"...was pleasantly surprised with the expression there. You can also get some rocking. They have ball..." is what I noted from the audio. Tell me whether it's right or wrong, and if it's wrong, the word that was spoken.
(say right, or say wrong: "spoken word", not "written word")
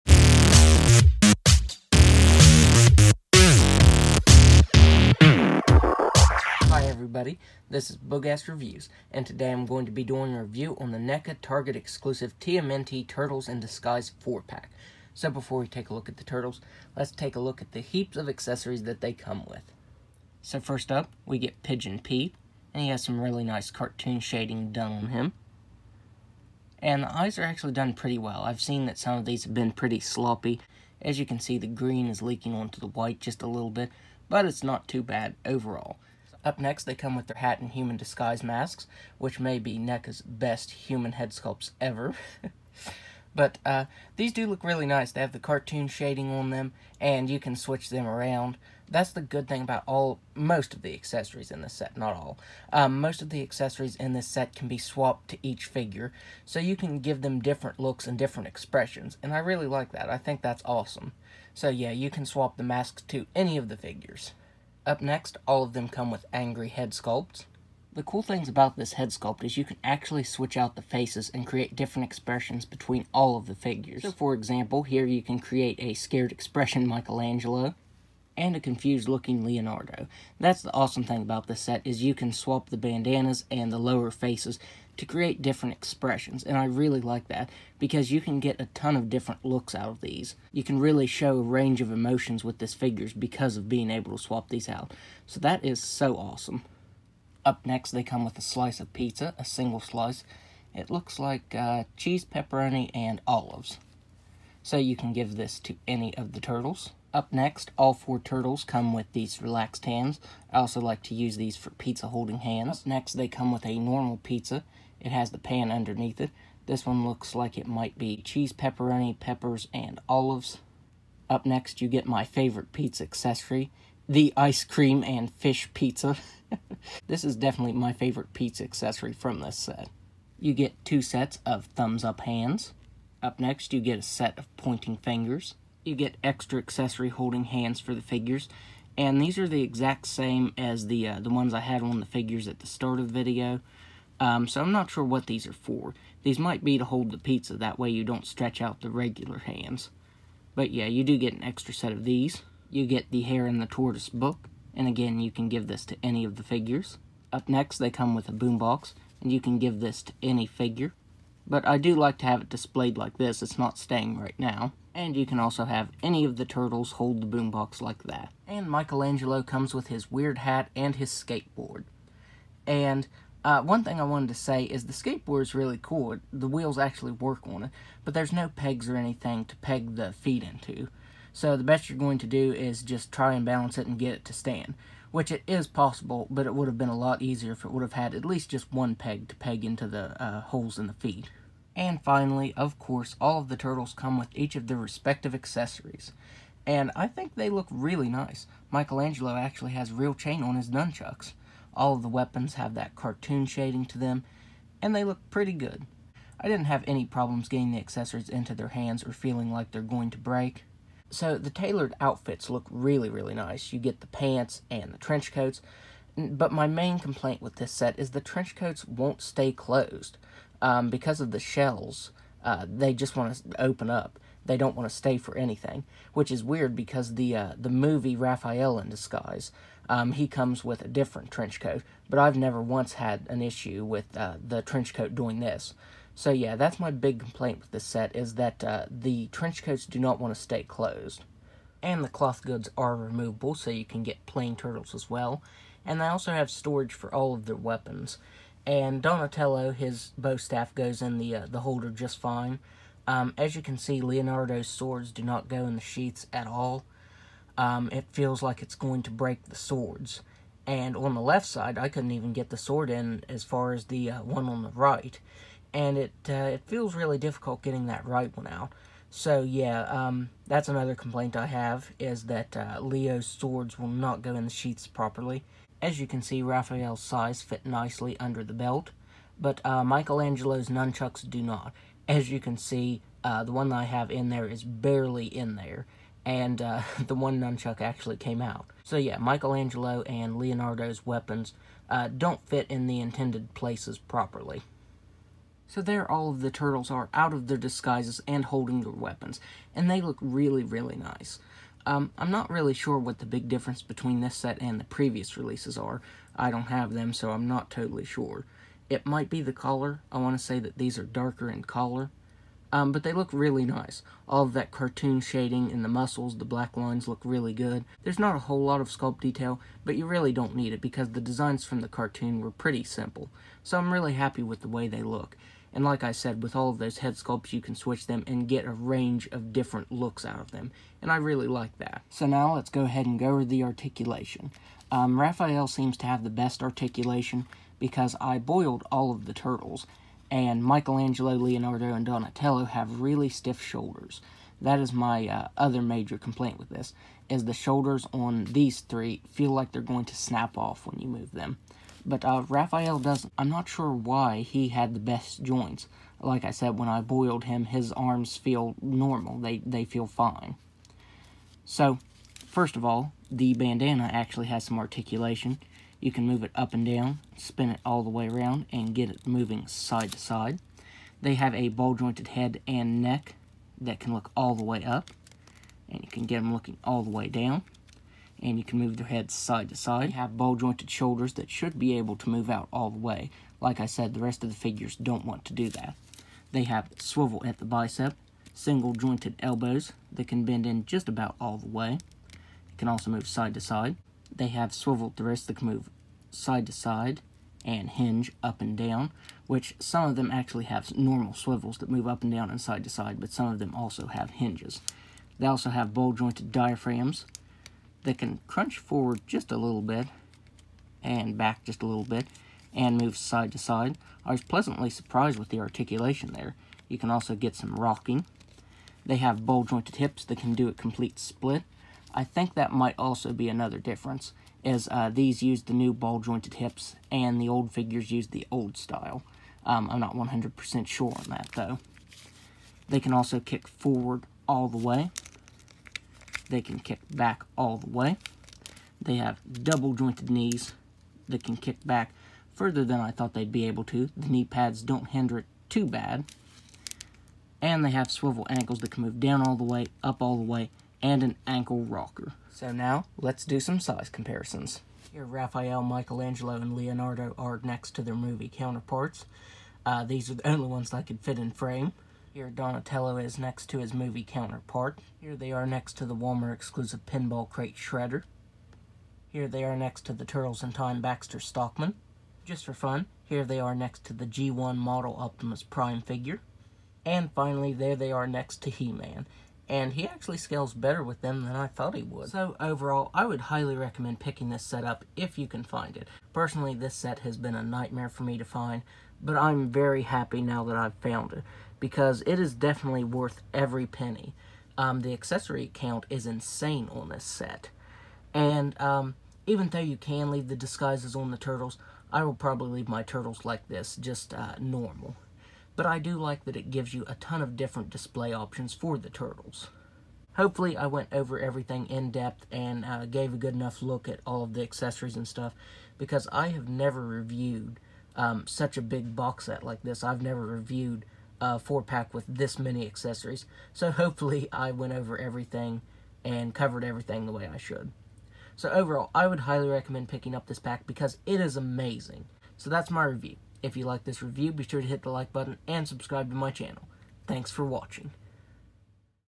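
wrong: "articulation", not "expression".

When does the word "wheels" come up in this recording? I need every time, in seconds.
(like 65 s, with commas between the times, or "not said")
176 s.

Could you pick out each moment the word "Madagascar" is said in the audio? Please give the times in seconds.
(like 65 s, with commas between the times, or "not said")
not said.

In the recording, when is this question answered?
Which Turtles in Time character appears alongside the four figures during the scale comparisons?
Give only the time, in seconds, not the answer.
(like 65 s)
471 s.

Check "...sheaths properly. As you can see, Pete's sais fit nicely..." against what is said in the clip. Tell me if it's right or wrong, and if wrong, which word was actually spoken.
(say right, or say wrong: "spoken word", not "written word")
wrong: "Raphael", not "Pete".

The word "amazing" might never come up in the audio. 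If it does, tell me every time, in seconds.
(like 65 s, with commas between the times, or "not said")
531 s.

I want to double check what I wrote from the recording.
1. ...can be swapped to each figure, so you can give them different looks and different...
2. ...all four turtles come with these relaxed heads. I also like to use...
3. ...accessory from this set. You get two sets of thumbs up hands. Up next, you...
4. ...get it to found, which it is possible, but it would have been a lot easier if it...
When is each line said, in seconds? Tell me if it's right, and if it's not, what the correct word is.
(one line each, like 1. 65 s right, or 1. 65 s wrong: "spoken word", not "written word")
1. 54 s right
2. 107 s wrong: "hands", not "heads"
3. 128 s right
4. 183 s wrong: "stand", not "found".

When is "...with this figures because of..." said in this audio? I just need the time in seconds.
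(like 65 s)
92 s.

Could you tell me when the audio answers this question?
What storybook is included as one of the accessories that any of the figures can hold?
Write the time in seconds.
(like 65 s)
153 s.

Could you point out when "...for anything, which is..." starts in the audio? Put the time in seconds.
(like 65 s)
225 s.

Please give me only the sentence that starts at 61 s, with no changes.
So yeah, you can swap the masks to any of the figures.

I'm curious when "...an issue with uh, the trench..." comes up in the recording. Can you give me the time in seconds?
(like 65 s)
233 s.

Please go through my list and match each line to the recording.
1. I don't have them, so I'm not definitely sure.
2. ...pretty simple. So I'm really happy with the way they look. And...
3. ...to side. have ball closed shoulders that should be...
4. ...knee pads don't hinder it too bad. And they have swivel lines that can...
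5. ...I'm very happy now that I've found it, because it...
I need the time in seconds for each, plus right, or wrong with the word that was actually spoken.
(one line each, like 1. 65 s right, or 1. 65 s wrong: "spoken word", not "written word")
1. 306 s wrong: "totally", not "definitely"
2. 322 s right
3. 379 s wrong: "jointed", not "closed"
4. 444 s wrong: "ankles", not "lines"
5. 489 s right.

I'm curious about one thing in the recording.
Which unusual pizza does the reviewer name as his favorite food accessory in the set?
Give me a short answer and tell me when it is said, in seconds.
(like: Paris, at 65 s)
ice cream and fish pizza, at 124 s.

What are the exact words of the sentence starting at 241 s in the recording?
And the cloth goods are removable, so you can get plain turtles as well.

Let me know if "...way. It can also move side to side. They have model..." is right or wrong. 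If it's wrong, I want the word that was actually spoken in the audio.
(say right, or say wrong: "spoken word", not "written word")
wrong: "swivel", not "model".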